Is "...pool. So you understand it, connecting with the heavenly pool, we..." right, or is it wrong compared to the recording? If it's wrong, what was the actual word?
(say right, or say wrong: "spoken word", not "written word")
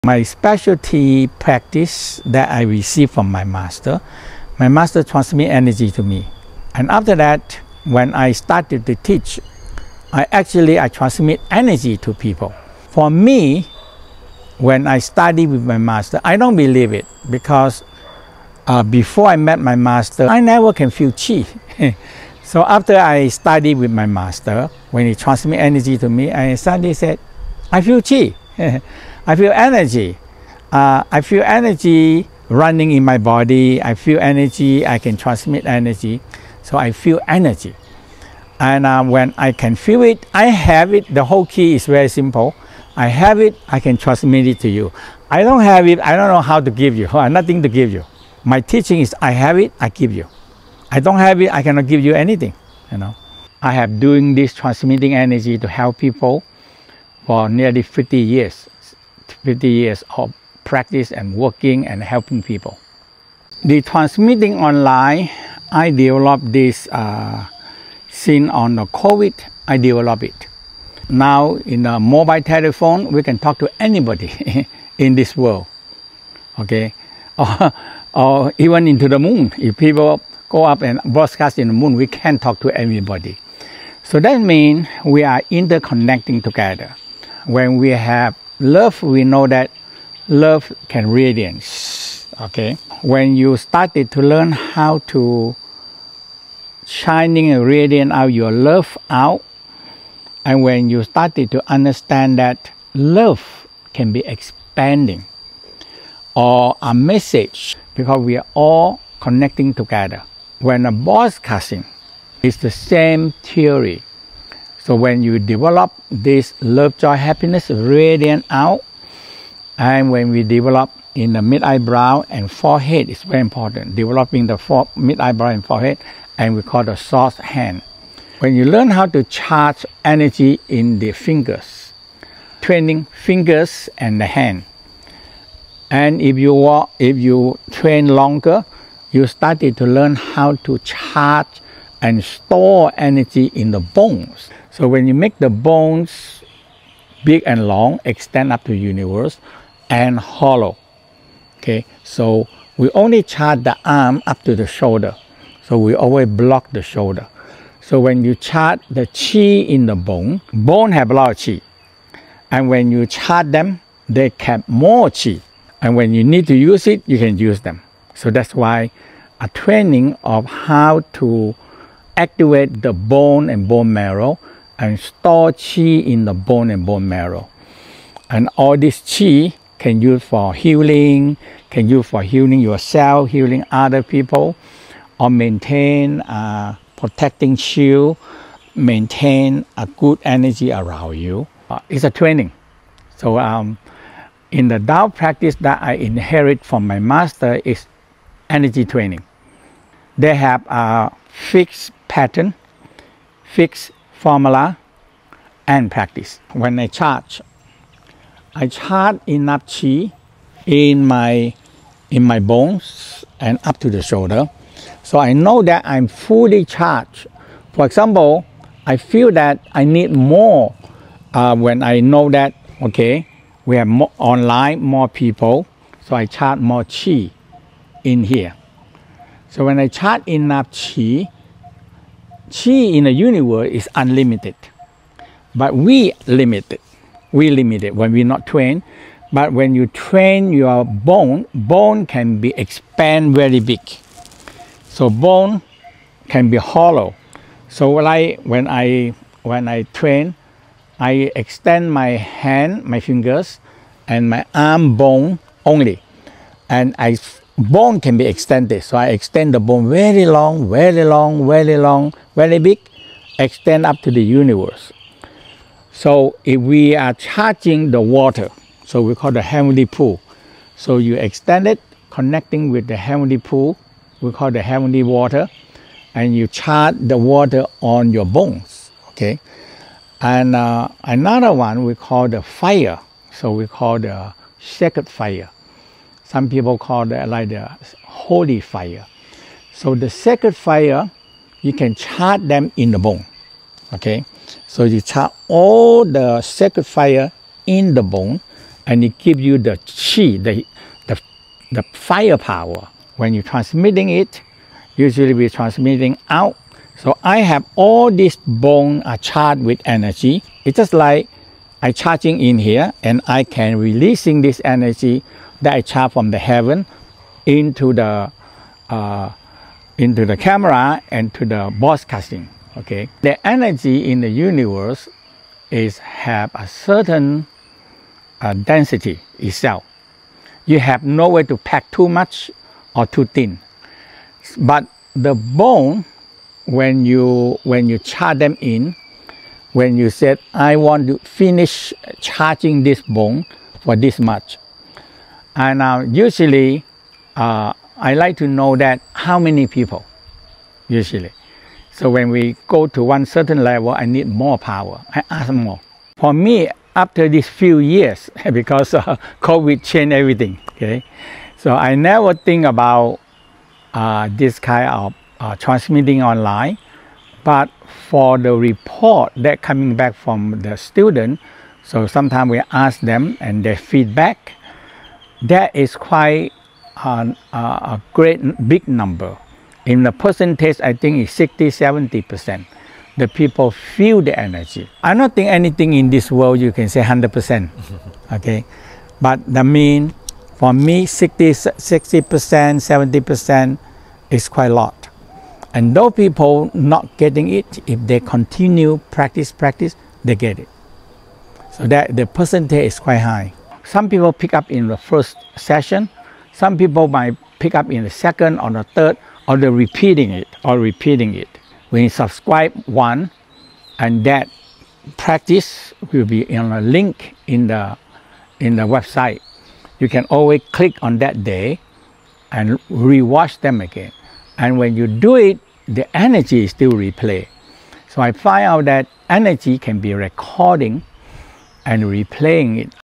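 wrong: "extend", not "understand".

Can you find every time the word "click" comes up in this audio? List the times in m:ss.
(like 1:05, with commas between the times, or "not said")
7:00.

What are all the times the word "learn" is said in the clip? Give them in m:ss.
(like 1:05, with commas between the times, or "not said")
1:34, 2:08, 2:19.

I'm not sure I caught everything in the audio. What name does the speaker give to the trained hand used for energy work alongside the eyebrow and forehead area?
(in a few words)
source hand.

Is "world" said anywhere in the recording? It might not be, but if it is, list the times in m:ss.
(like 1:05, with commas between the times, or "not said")
1:15, 6:26.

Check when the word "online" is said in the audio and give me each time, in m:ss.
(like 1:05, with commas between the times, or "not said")
1:04, 3:44, 6:06.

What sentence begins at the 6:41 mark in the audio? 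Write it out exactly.
So that the percentage is quite high.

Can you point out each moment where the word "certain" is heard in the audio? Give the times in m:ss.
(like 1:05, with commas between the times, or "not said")
5:26, 5:53.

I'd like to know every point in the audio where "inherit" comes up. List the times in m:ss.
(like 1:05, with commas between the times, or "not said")
3:16.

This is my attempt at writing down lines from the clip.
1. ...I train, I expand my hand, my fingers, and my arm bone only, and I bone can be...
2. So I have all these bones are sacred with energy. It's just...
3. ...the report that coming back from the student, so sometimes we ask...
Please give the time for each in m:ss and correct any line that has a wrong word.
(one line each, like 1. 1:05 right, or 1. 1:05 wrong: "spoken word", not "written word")
1. 4:09 wrong: "extend", not "expand"
2. 5:07 wrong: "charged", not "sacred"
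3. 6:08 right.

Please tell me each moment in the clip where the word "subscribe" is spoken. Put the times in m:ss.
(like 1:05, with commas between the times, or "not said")
6:52.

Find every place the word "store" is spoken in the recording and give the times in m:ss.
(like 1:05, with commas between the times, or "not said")
2:22, 2:55.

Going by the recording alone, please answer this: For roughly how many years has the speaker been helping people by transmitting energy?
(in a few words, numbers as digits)
50 years.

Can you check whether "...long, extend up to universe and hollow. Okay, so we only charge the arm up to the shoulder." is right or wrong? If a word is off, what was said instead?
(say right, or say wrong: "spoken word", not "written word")
right.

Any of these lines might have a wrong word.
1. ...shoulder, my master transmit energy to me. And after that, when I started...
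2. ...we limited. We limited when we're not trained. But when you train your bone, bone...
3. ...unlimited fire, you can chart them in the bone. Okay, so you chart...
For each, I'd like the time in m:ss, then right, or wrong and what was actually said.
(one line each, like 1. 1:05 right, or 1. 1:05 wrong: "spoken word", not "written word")
1. 0:03 wrong: "master", not "shoulder"
2. 3:55 right
3. 4:50 wrong: "sacred", not "unlimited".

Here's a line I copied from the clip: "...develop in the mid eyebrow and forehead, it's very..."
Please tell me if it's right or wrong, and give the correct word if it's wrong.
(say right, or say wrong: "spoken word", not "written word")
right.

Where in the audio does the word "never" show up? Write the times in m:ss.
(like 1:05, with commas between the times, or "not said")
0:20, 6:01.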